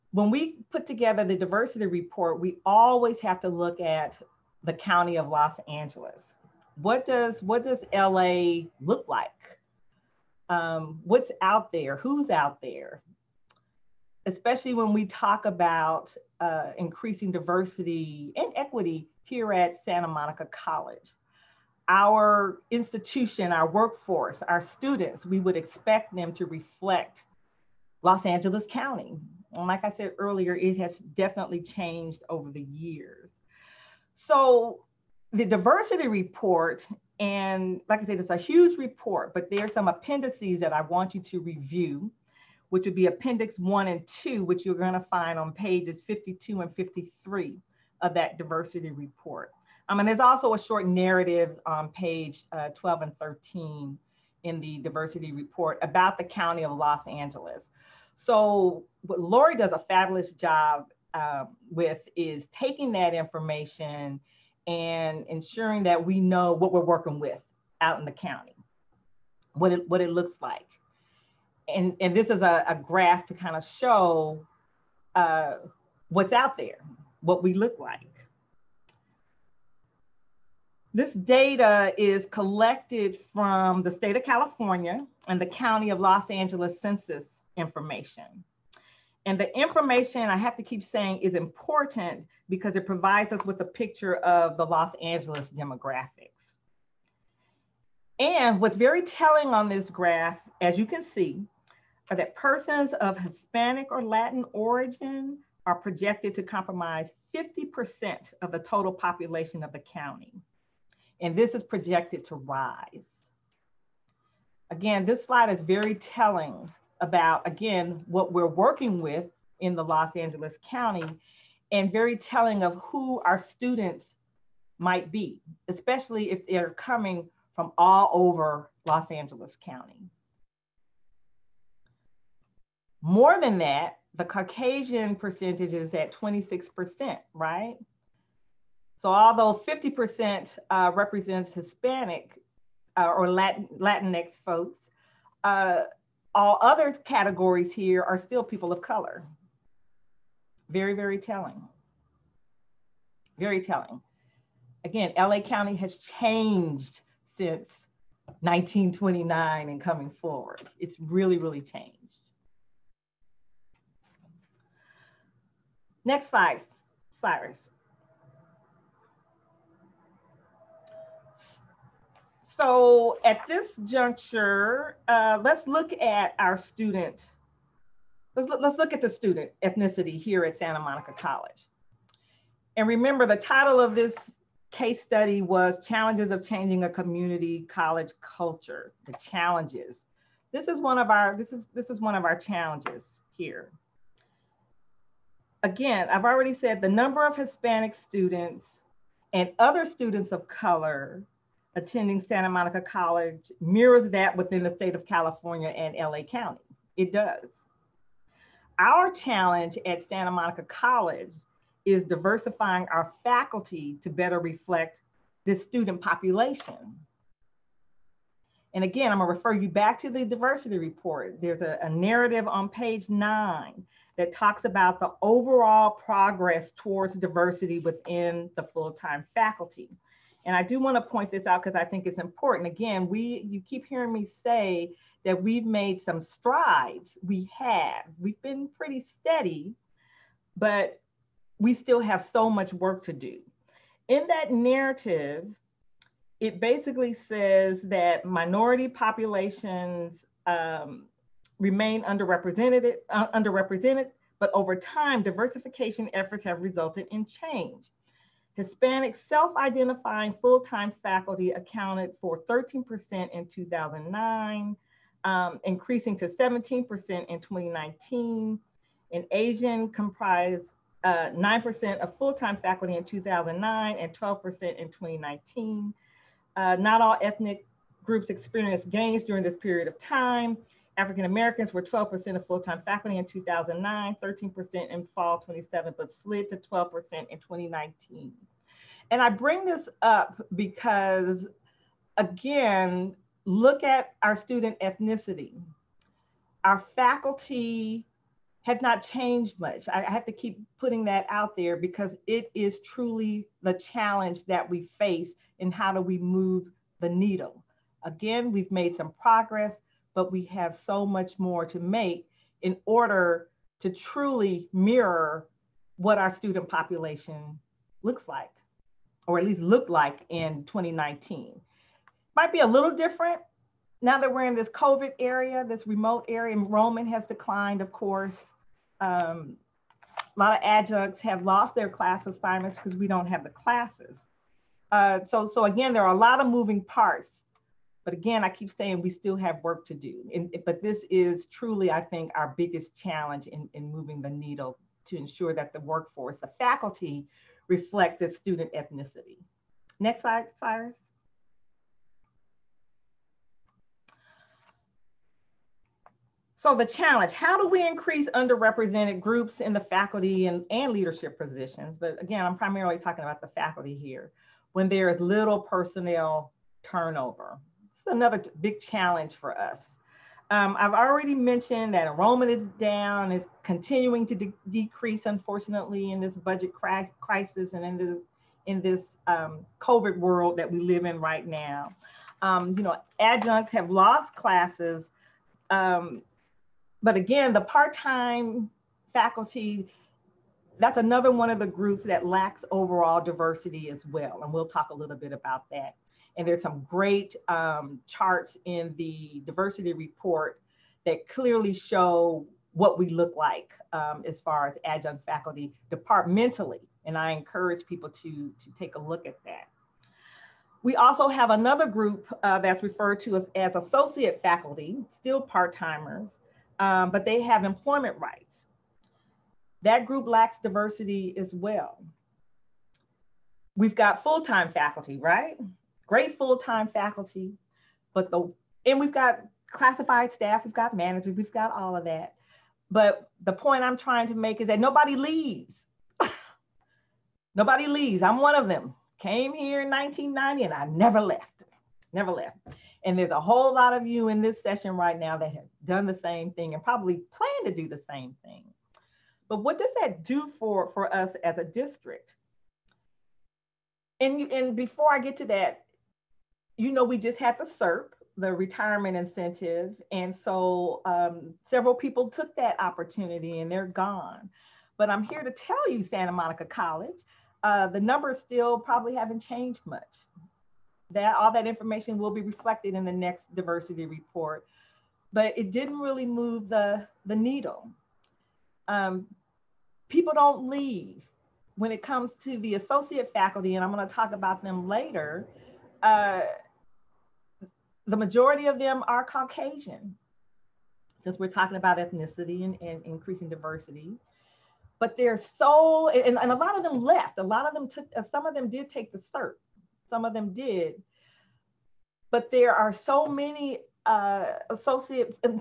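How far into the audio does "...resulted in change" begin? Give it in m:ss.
4:16.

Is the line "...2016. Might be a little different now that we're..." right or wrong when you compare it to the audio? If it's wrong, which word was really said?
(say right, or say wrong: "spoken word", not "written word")
wrong: "2019", not "2016".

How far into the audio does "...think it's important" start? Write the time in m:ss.
3:51.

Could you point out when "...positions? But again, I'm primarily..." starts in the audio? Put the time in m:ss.
6:01.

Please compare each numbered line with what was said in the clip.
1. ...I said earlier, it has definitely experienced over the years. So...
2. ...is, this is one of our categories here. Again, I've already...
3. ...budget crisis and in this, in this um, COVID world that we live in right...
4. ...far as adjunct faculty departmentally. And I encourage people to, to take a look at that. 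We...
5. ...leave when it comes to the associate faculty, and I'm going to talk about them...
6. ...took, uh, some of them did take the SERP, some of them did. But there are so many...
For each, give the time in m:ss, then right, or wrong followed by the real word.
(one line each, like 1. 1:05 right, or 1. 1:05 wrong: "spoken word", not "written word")
1. 0:29 wrong: "changed", not "experienced"
2. 3:11 wrong: "challenges", not "categories"
3. 6:16 right
4. 6:44 right
5. 8:00 right
6. 8:17 right.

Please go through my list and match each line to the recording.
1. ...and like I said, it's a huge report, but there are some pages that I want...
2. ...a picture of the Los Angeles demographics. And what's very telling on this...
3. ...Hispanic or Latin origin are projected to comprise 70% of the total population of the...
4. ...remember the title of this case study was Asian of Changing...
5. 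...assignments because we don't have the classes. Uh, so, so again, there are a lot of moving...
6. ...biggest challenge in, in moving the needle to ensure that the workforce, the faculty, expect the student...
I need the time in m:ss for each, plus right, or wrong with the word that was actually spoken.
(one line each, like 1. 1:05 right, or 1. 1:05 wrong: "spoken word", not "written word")
1. 0:37 wrong: "appendices", not "pages"
2. 1:33 right
3. 1:43 wrong: "50", not "70"
4. 3:02 wrong: "Challenges", not "Asian"
5. 5:32 right
6. 5:42 wrong: "reflect", not "expect".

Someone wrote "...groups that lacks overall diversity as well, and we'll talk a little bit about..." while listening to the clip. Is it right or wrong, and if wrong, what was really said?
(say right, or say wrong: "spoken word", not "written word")
right.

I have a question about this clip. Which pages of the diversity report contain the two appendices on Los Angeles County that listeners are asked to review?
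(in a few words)
52 and 53.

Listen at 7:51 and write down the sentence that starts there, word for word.
That all that information will be reflected in the next diversity report, but it didn't really move the the needle.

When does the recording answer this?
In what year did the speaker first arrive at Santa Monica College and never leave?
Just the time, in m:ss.
7:19.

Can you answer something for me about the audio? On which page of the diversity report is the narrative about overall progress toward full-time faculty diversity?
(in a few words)
9.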